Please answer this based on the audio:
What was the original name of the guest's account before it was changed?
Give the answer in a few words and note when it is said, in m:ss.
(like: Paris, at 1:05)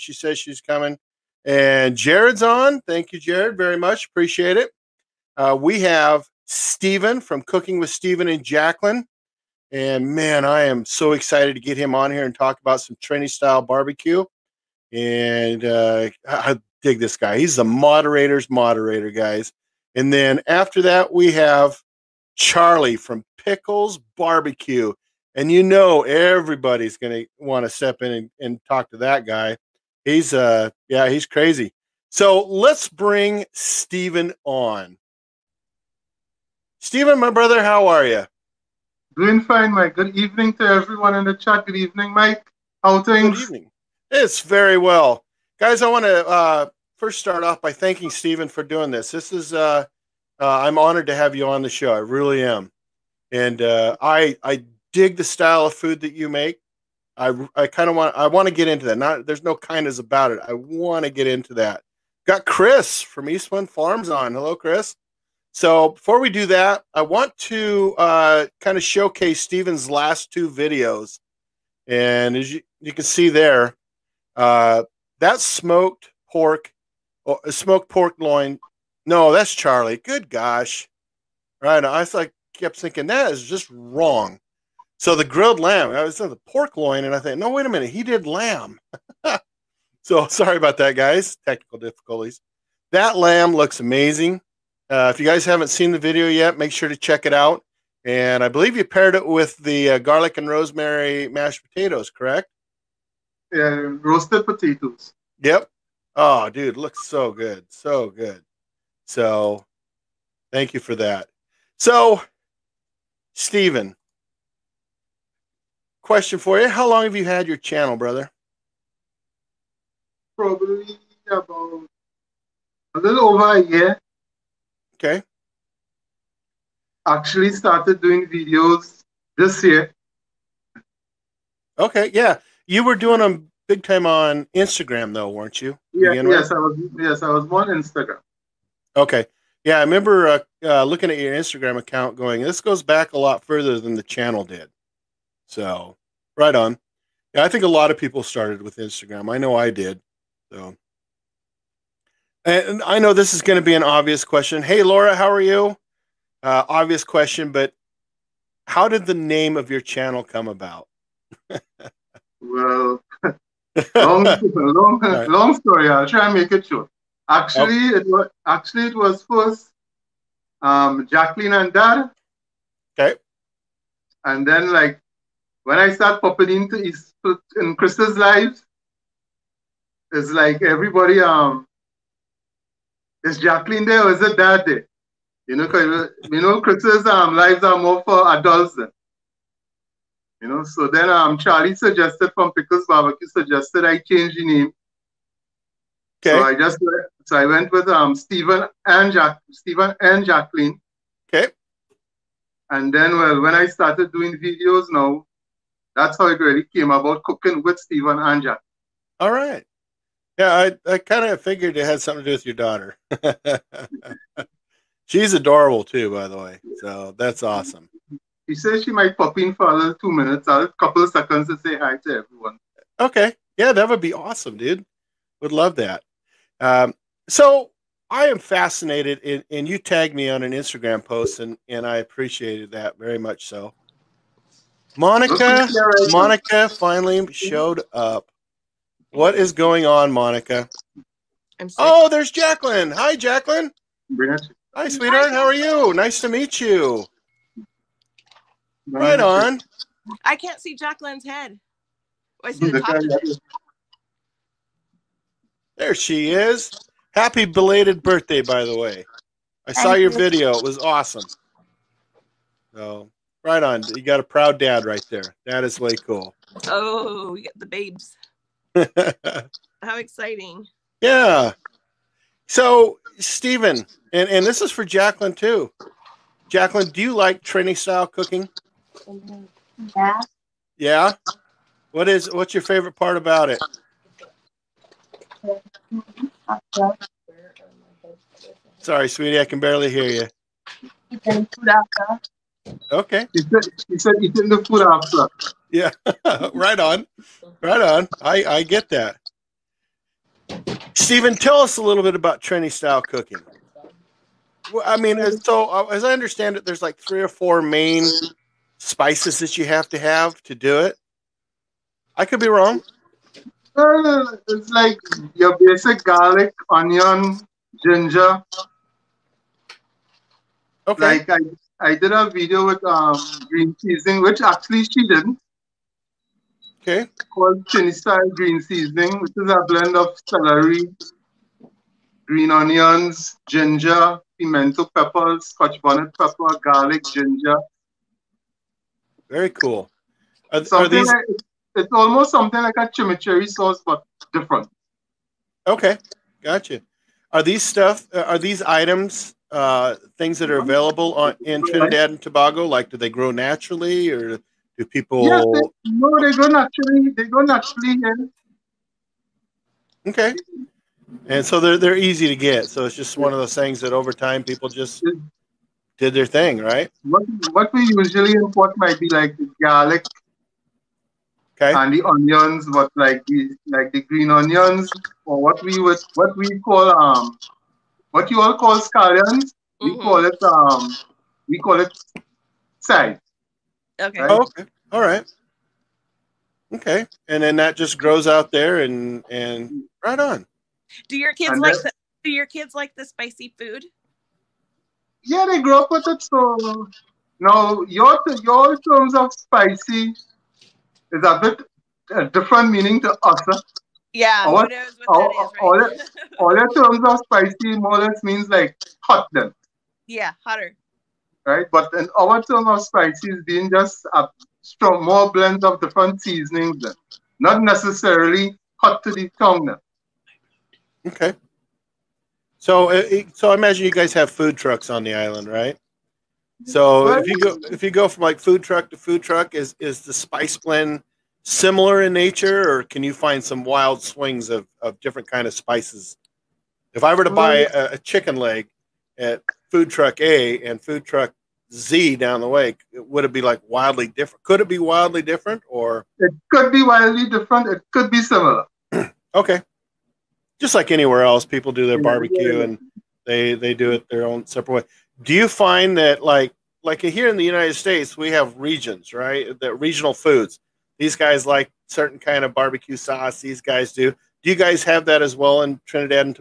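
Jacklyn and Dad, at 2:51.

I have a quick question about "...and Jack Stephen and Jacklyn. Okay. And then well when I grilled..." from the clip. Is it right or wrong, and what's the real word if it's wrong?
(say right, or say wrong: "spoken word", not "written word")
wrong: "started", not "grilled".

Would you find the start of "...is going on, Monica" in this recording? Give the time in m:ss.
3:59.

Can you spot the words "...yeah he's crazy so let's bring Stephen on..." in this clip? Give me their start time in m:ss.
0:30.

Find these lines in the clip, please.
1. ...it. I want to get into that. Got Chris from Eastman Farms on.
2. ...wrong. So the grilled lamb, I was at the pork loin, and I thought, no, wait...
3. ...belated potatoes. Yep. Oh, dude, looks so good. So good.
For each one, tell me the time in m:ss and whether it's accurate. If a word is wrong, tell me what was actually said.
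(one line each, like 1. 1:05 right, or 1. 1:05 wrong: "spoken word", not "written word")
1. 1:00 right
2. 1:23 right
3. 1:44 wrong: "roasted", not "belated".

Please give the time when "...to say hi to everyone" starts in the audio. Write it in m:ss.
3:41.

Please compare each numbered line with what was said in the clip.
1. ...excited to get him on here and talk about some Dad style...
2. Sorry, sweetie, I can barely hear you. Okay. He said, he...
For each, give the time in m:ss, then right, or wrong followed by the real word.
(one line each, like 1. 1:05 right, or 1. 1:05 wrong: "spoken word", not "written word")
1. 0:11 wrong: "Trini", not "Dad"
2. 4:48 right.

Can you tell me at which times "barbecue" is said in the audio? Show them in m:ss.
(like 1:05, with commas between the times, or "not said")
0:13, 0:24, 3:12, 7:32, 7:42.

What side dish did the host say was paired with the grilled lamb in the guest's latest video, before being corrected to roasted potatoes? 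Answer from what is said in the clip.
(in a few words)
garlic and rosemary mashed potatoes.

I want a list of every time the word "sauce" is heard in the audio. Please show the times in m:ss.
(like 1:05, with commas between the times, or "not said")
5:43, 7:42.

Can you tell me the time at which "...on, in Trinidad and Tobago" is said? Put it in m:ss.
5:51.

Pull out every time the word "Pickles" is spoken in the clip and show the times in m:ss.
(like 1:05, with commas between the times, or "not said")
0:23, 3:12.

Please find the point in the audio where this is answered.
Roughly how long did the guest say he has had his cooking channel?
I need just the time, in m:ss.
2:02.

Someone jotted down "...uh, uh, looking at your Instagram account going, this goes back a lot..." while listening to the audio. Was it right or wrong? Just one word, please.
right.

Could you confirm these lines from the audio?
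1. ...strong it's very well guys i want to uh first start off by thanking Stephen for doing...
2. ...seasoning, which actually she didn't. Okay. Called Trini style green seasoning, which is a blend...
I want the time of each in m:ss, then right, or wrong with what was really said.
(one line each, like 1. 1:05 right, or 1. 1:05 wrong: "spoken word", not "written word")
1. 0:43 wrong: "evening", not "strong"
2. 5:23 right.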